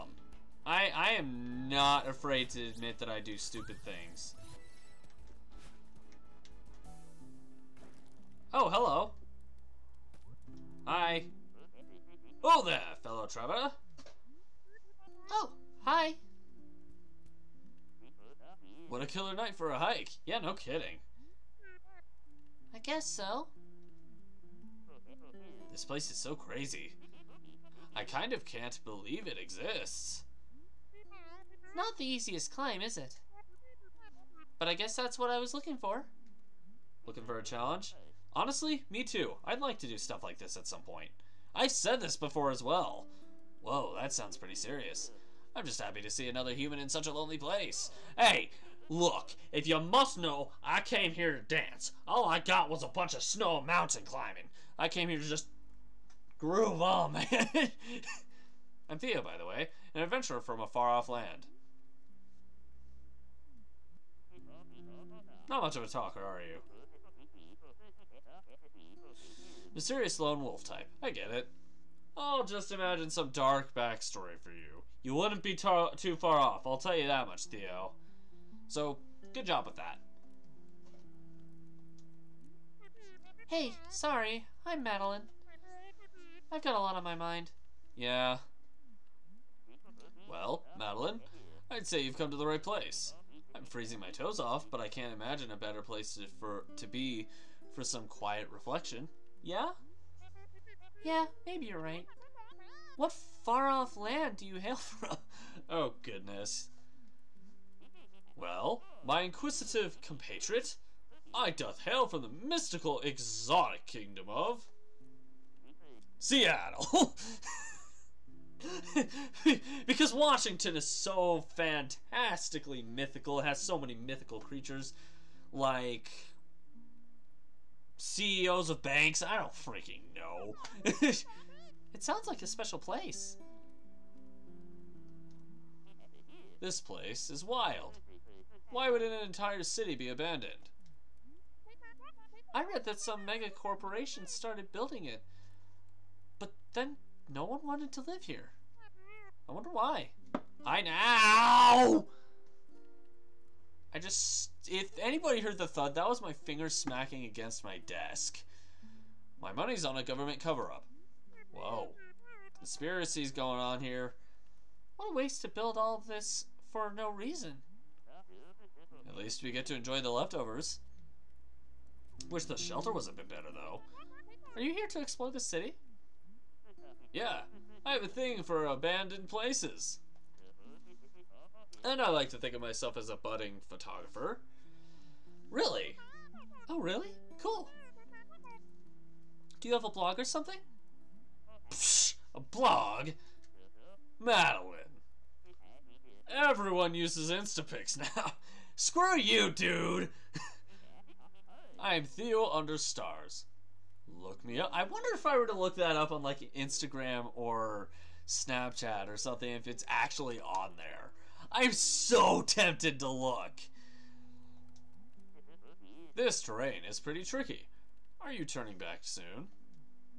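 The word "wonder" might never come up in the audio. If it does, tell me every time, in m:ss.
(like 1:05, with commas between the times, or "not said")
2:29, 3:24.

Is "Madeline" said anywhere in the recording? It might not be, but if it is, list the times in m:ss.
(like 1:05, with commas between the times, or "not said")
1:24, 1:30, 3:14.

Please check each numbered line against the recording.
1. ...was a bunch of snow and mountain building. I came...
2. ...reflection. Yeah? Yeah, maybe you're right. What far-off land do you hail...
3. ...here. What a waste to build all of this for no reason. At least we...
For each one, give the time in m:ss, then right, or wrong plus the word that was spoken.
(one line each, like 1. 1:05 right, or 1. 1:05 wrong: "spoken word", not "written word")
1. 0:52 wrong: "climbing", not "building"
2. 1:38 right
3. 2:43 right.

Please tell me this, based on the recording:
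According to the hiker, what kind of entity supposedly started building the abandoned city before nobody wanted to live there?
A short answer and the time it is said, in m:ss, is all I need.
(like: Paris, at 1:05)
mega corporation, at 2:23.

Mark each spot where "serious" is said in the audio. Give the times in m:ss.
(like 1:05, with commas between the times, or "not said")
0:44.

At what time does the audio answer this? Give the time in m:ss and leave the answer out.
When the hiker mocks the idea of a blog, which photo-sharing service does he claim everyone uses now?
3:17.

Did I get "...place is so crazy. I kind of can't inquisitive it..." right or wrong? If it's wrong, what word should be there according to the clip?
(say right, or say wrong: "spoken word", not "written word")
wrong: "believe", not "inquisitive".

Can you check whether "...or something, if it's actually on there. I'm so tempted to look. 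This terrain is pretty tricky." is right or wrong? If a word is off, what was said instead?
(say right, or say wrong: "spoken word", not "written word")
right.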